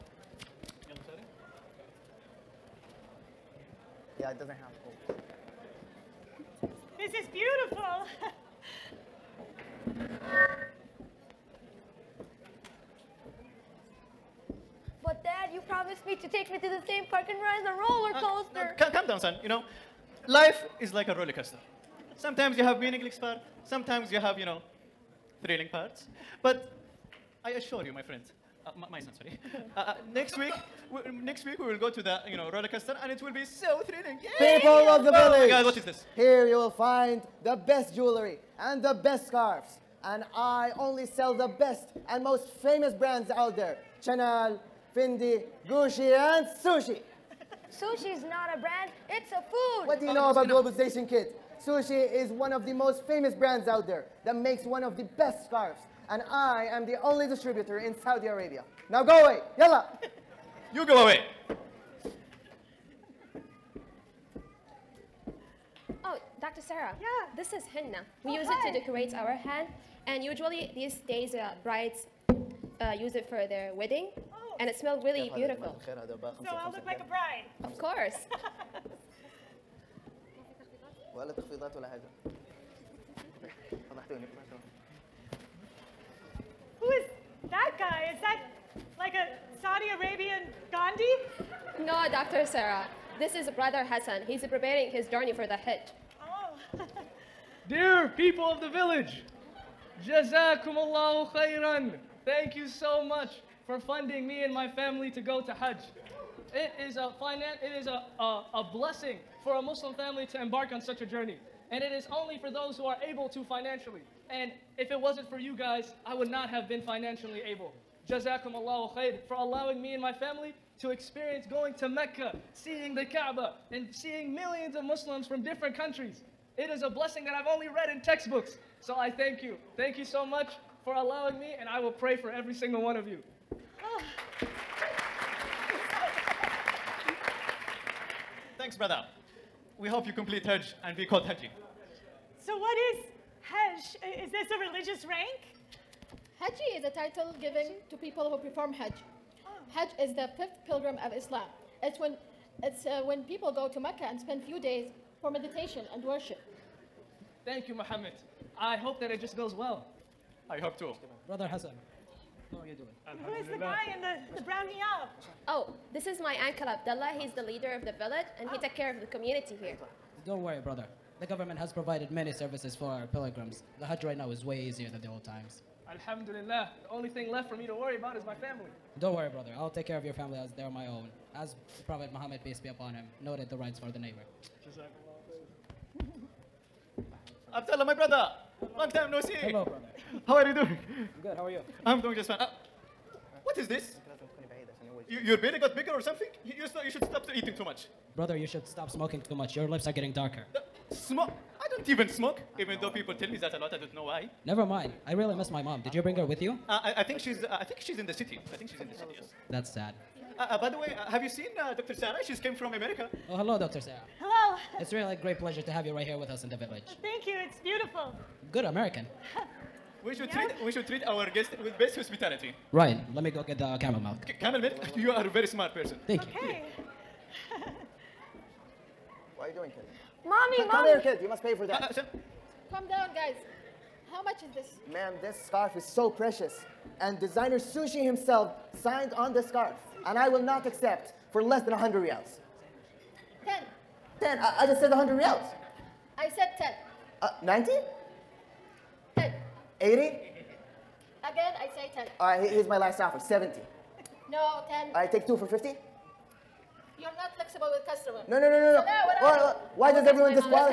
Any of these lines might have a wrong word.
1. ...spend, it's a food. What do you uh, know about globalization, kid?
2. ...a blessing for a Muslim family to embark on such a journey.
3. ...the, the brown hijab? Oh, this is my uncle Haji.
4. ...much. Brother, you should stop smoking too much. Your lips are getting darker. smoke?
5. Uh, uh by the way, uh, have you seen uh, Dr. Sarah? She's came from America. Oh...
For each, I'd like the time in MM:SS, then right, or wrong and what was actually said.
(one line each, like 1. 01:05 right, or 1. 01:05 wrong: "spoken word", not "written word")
1. 00:48 wrong: "brand", not "spend"
2. 01:48 right
3. 02:44 wrong: "Abdullah", not "Haji"
4. 03:17 right
5. 03:30 right.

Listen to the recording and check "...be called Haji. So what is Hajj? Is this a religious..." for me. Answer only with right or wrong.
right.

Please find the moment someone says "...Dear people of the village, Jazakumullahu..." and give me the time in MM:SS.
01:37.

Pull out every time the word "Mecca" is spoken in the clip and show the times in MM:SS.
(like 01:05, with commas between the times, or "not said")
02:01, 02:33.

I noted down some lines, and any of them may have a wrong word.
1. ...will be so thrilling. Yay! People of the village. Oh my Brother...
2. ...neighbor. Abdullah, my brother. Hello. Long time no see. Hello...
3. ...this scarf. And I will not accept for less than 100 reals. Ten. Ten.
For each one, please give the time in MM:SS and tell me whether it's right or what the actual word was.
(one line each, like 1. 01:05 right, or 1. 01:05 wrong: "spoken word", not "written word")
1. 00:33 wrong: "God", not "Brother"
2. 03:03 right
3. 03:59 right.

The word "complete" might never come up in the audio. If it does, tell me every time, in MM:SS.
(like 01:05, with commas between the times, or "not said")
02:20.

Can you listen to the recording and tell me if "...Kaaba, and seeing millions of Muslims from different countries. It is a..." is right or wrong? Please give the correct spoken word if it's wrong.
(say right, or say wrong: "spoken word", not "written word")
right.